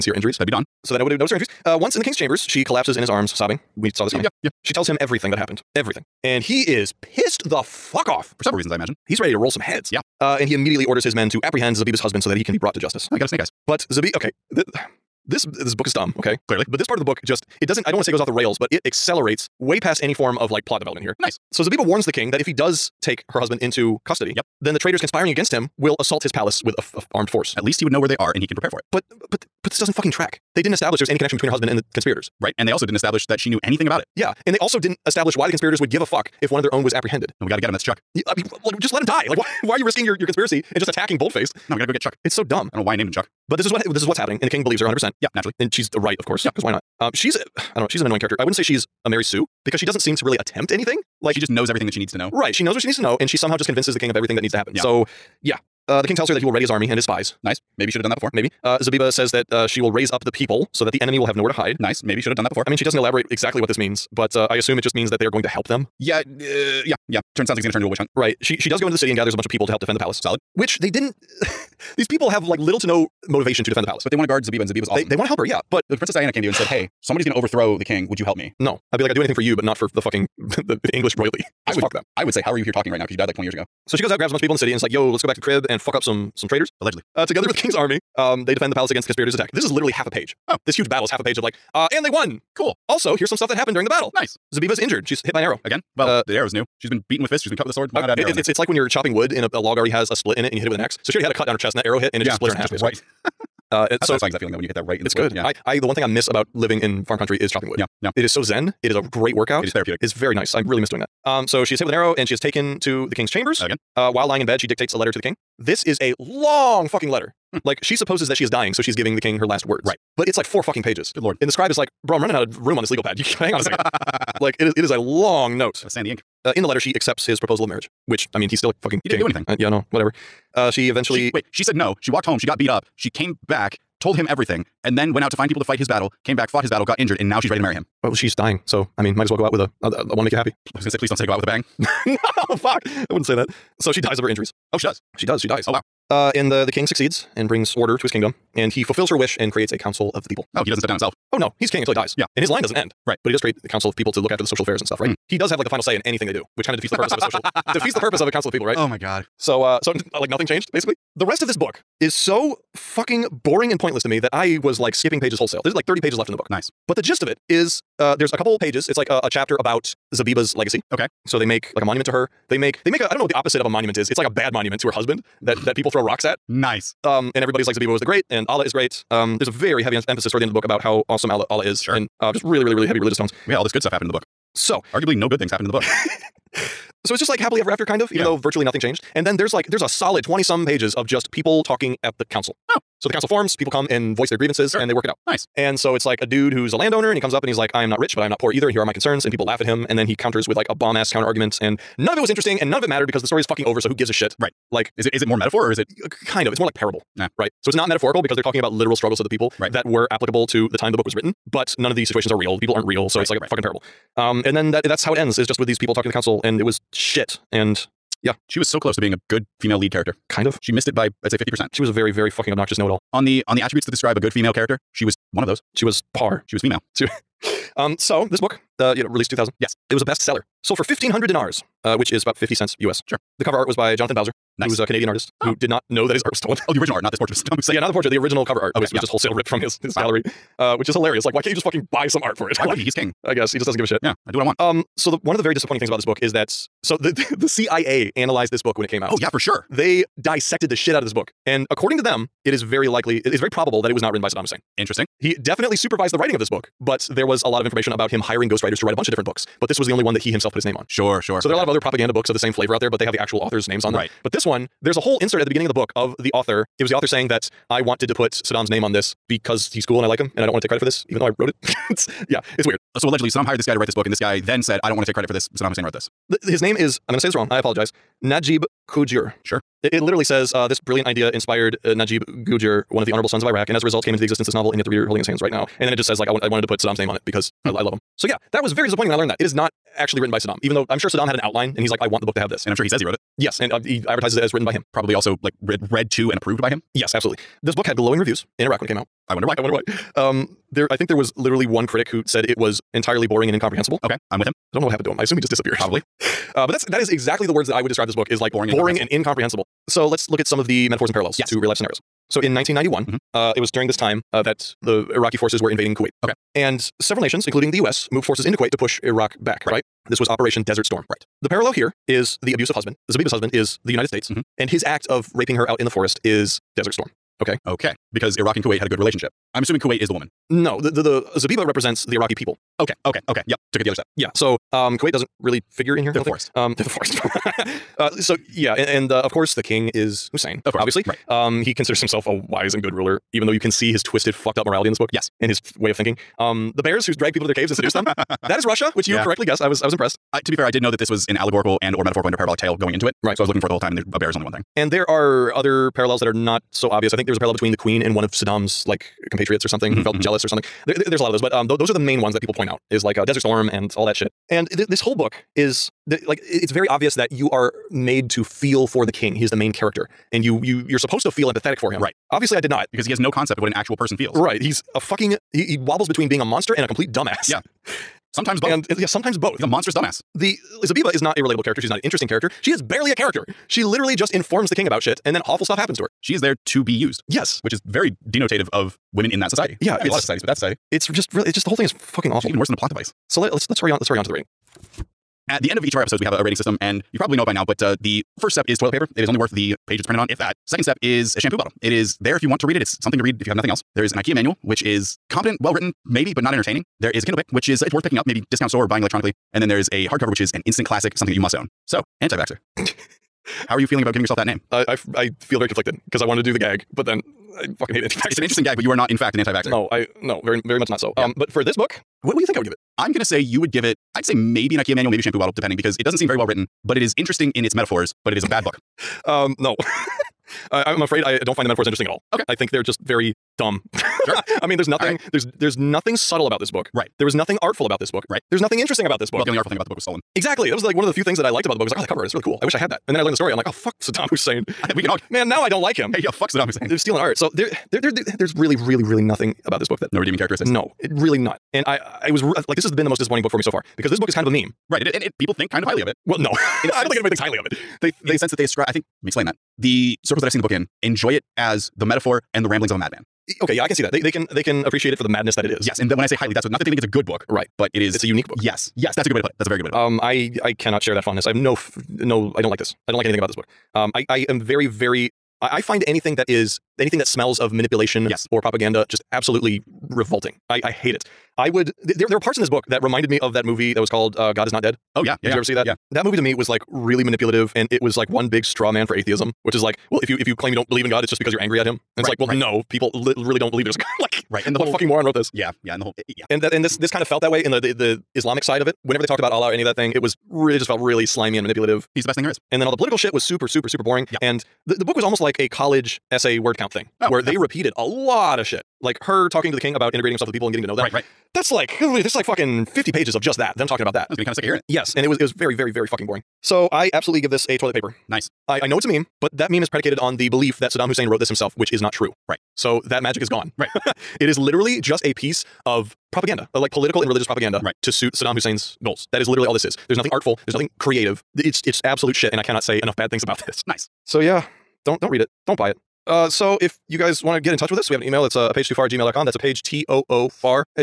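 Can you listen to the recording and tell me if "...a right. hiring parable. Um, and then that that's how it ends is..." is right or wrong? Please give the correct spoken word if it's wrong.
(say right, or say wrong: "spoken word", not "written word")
wrong: "fucking", not "hiring".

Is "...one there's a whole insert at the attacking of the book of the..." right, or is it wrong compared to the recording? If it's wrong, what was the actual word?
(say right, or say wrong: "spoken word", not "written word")
wrong: "beginning", not "attacking".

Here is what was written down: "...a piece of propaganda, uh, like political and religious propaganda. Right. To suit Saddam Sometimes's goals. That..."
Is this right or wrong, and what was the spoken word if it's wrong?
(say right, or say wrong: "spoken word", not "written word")
wrong: "Hussein", not "Sometimes".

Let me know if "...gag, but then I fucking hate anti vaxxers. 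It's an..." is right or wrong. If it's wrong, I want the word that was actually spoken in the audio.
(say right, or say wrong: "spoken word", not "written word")
right.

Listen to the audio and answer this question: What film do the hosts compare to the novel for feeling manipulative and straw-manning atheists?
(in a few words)
God Is Not Dead.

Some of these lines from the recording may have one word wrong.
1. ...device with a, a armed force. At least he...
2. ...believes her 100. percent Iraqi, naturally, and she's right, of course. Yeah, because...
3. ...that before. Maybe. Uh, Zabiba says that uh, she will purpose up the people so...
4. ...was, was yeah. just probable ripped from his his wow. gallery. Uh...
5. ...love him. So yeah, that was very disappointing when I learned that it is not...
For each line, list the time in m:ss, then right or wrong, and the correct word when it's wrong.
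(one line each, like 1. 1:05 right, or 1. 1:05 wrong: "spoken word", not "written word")
1. 0:26 wrong: "palace", not "device"
2. 0:44 wrong: "Yeah", not "Iraqi"
3. 0:58 wrong: "raise", not "purpose"
4. 3:58 wrong: "wholesale", not "probable"
5. 4:47 right.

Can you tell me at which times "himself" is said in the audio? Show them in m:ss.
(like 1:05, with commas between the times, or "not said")
2:30, 4:20, 5:42, 8:30, 8:41.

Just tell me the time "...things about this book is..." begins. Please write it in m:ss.
4:05.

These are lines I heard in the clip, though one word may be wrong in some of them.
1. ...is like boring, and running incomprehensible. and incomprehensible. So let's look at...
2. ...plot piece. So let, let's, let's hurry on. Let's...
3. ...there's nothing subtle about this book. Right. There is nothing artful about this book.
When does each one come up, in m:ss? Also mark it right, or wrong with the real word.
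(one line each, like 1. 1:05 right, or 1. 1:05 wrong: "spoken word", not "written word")
1. 5:08 wrong: "boring", not "running"
2. 6:32 wrong: "device", not "piece"
3. 7:15 right.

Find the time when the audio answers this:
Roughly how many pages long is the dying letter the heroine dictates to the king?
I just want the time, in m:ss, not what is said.
2:00.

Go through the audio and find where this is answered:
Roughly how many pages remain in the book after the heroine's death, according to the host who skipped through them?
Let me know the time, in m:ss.
2:45.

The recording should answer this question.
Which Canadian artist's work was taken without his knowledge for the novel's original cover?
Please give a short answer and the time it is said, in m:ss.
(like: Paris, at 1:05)
Jonathan Bowser, at 3:53.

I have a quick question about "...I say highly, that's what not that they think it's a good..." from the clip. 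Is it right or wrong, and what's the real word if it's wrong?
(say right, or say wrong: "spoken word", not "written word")
right.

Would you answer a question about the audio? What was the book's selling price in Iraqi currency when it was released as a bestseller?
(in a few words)
1,500 dinars.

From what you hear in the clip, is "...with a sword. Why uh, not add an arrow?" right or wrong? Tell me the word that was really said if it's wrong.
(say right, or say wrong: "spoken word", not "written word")
right.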